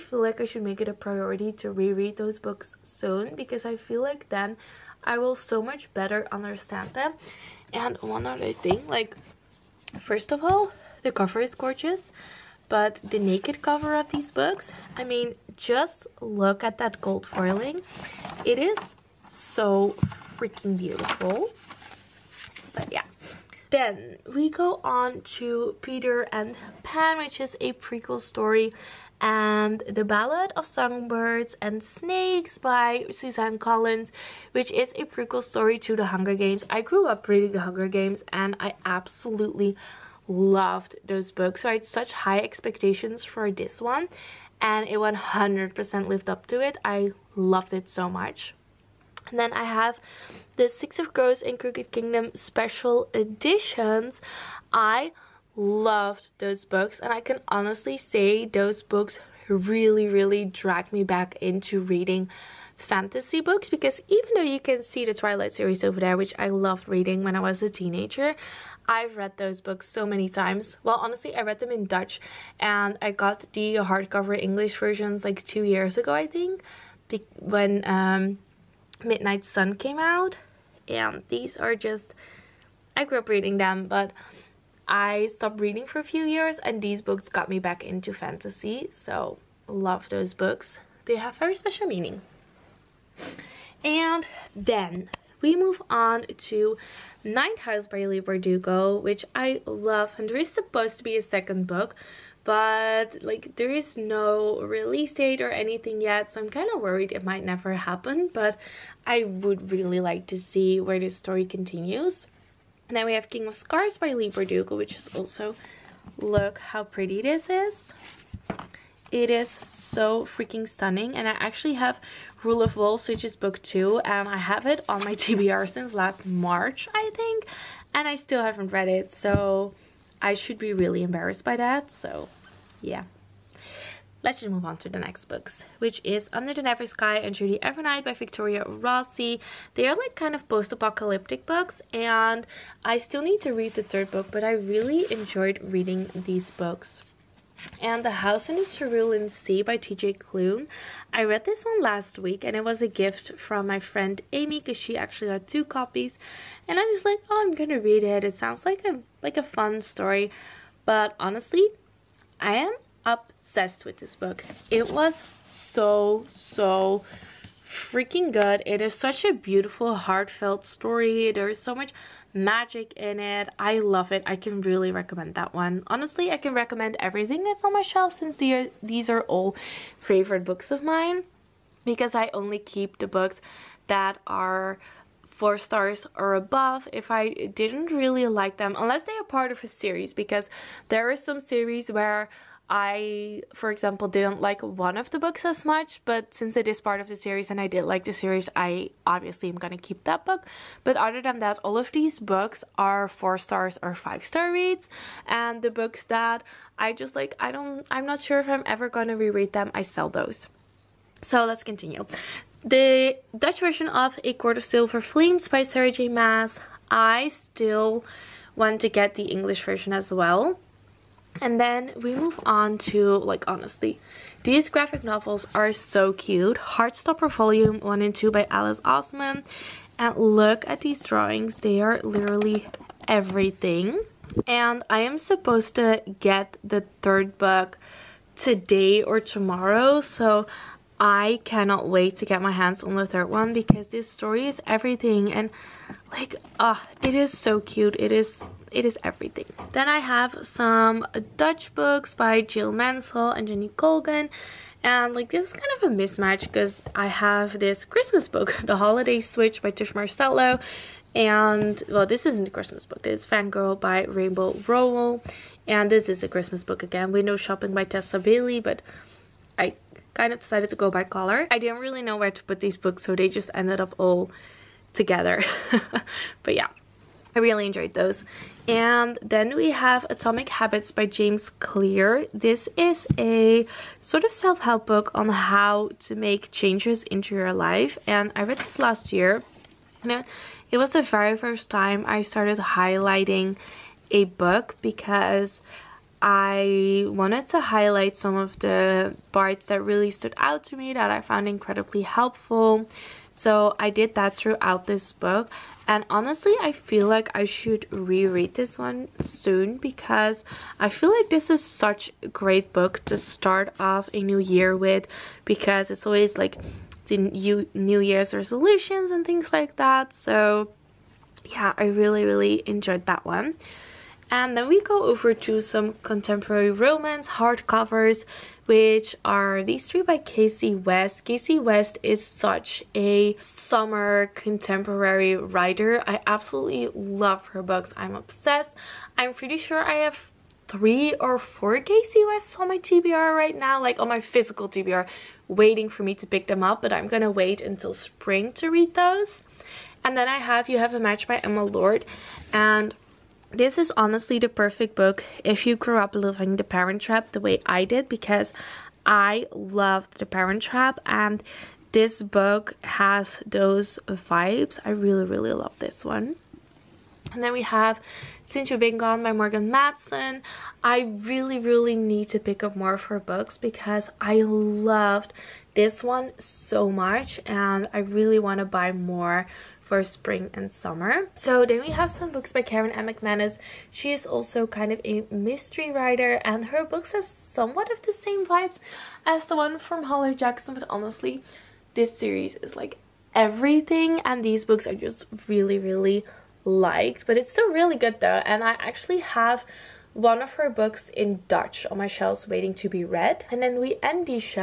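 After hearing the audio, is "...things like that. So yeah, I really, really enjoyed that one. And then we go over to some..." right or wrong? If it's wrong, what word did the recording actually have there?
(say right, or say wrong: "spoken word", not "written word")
right.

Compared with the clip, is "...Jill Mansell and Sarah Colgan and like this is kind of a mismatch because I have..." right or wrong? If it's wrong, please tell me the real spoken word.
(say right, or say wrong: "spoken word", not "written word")
wrong: "Jenny", not "Sarah".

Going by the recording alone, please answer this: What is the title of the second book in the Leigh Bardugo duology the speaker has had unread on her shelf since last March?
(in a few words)
Rule of Wolves.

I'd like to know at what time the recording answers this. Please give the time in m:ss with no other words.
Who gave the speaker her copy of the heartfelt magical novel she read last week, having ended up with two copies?
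2:34.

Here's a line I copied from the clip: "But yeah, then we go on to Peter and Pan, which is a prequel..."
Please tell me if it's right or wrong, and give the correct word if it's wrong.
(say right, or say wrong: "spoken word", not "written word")
right.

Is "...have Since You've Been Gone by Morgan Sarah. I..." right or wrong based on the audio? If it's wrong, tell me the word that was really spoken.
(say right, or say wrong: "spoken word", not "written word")
wrong: "Matson", not "Sarah".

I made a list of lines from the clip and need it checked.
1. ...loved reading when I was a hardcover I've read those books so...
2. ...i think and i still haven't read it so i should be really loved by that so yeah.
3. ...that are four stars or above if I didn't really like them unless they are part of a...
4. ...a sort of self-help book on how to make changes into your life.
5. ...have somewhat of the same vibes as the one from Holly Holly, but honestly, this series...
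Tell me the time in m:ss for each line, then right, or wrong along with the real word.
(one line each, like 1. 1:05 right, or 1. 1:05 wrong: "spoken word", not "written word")
1. 1:06 wrong: "teenager", not "hardcover"
2. 2:06 wrong: "embarrassed", not "loved"
3. 3:03 right
4. 4:43 right
5. 6:27 wrong: "Jackson", not "Holly".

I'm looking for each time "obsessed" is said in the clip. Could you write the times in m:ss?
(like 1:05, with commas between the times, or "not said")
2:43, 5:38.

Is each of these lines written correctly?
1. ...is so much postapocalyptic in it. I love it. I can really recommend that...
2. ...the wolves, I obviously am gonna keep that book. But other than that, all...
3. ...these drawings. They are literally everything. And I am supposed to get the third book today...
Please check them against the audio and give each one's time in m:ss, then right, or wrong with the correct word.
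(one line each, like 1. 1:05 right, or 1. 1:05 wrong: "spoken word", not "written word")
1. 2:51 wrong: "magic", not "postapocalyptic"
2. 3:18 wrong: "series", not "wolves"
3. 3:50 right.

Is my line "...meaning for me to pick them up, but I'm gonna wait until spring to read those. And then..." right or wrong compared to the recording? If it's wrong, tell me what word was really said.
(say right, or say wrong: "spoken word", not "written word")
wrong: "waiting", not "meaning".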